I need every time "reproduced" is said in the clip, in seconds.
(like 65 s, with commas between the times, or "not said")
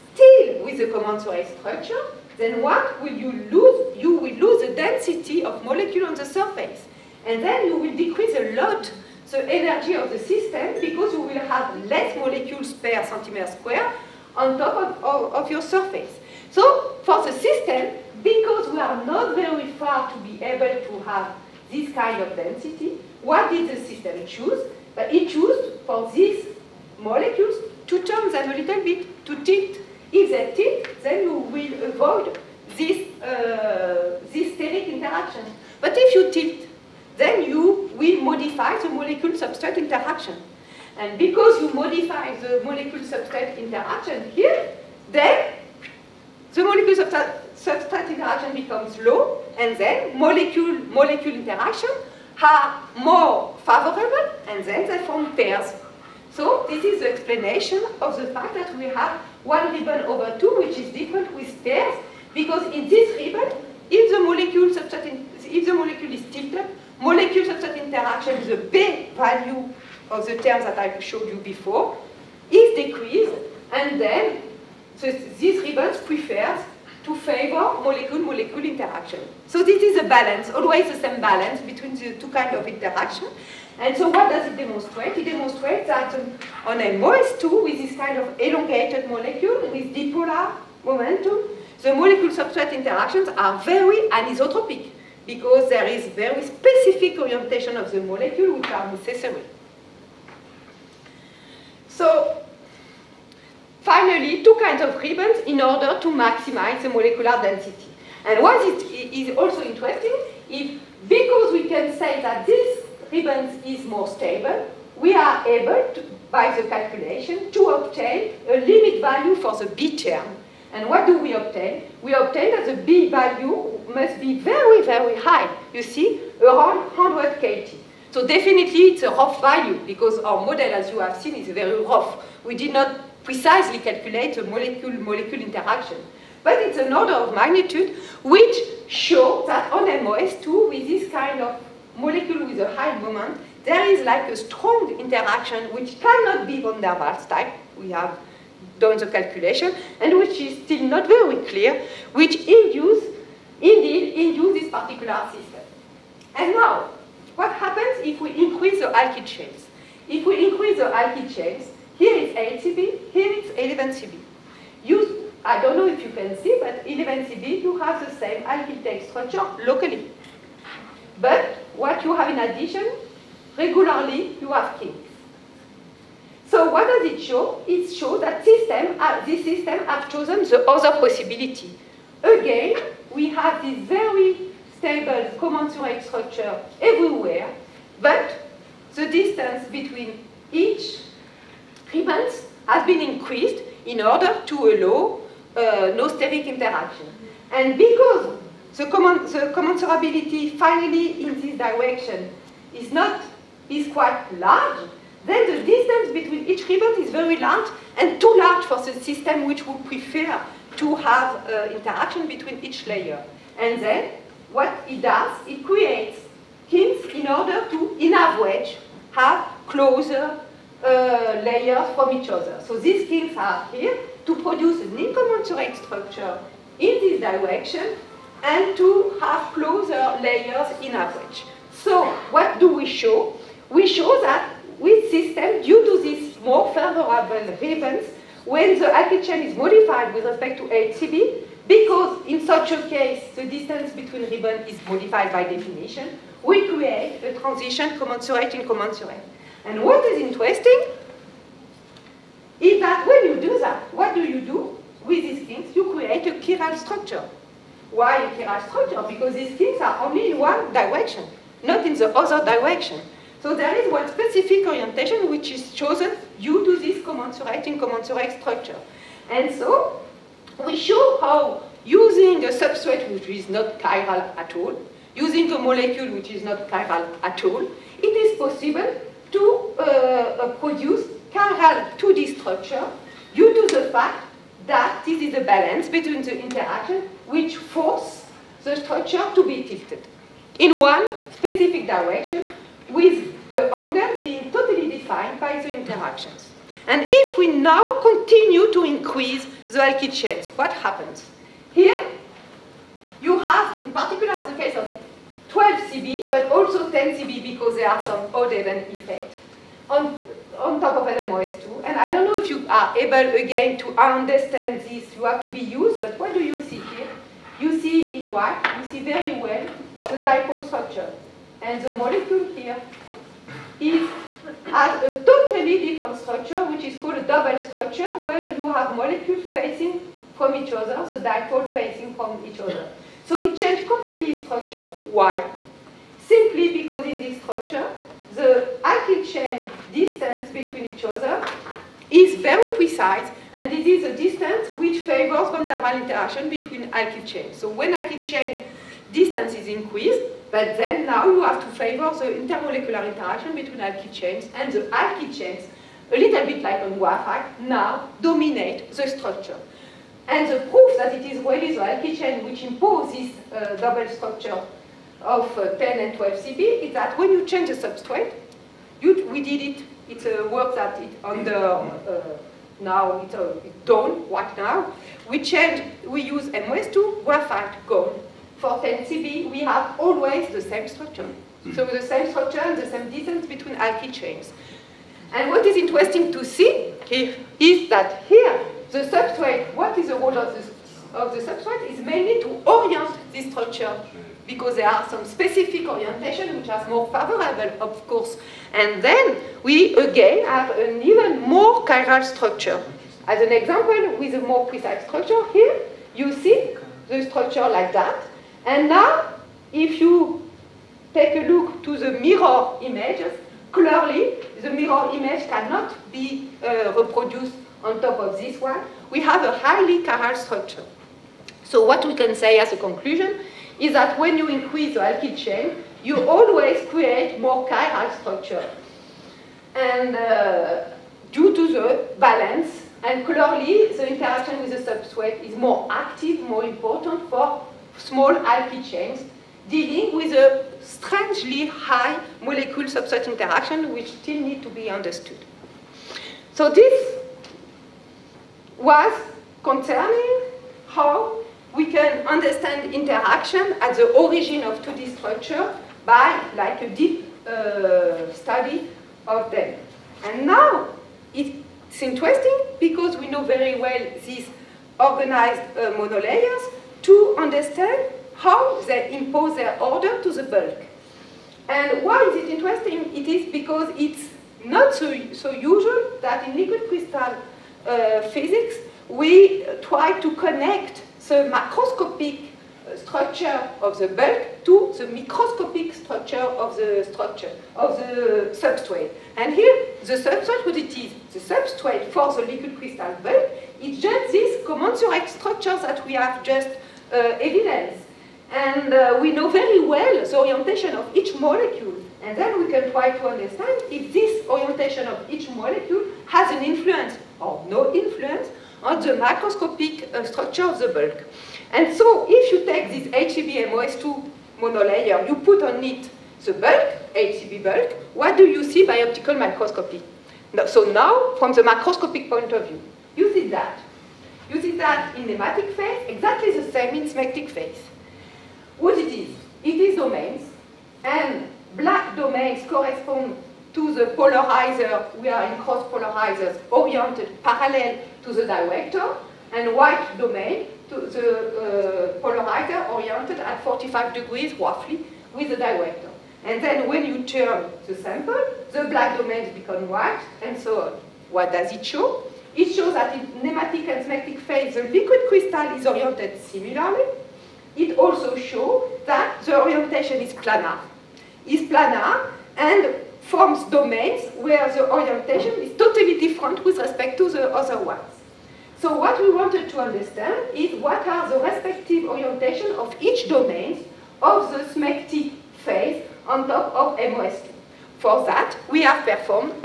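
416 s.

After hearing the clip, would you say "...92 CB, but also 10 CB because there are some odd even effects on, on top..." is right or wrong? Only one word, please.
wrong.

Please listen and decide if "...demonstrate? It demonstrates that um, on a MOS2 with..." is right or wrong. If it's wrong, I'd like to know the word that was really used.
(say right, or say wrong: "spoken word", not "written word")
right.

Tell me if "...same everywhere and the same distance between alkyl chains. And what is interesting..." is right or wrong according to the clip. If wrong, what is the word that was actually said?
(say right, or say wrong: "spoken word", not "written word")
wrong: "structure", not "everywhere".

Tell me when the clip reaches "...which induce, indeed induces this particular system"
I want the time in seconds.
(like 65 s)
152 s.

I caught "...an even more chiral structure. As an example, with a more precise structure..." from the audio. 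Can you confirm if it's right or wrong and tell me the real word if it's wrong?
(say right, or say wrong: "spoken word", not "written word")
right.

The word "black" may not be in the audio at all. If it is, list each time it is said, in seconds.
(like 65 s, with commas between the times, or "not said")
531 s, 548 s.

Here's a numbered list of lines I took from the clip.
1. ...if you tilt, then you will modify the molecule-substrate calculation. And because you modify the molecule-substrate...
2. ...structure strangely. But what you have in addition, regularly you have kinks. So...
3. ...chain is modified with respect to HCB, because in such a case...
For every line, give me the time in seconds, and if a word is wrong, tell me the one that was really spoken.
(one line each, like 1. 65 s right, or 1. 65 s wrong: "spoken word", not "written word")
1. 35 s wrong: "interaction", not "calculation"
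2. 169 s wrong: "locally", not "strangely"
3. 239 s right.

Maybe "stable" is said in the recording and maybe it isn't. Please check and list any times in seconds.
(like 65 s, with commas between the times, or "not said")
114 s, 184 s.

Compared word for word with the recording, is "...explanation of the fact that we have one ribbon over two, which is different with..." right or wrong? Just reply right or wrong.
right.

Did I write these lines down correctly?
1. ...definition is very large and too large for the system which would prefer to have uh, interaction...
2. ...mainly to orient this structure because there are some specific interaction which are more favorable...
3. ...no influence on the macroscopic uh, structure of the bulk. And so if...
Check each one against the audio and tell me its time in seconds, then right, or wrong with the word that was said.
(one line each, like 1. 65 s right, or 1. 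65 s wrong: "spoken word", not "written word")
1. 206 s wrong: "ribbon", not "definition"
2. 391 s wrong: "orientation", not "interaction"
3. 507 s right.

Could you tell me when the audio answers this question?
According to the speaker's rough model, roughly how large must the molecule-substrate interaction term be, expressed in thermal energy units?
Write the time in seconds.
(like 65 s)
126 s.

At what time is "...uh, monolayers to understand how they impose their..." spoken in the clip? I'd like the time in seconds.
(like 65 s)
465 s.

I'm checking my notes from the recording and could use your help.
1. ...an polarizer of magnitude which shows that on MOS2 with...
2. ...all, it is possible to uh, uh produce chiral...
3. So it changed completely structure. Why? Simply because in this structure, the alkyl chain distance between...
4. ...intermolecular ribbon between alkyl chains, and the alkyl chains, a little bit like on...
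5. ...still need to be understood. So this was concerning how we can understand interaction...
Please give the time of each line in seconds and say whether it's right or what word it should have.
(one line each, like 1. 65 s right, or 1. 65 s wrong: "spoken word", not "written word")
1. 136 s wrong: "order", not "polarizer"
2. 277 s right
3. 333 s right
4. 352 s wrong: "interaction", not "ribbon"
5. 444 s right.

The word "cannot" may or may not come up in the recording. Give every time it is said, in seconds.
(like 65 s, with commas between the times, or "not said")
145 s, 415 s.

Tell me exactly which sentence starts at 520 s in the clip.
No, so now, from the macroscopic point of view, you see that.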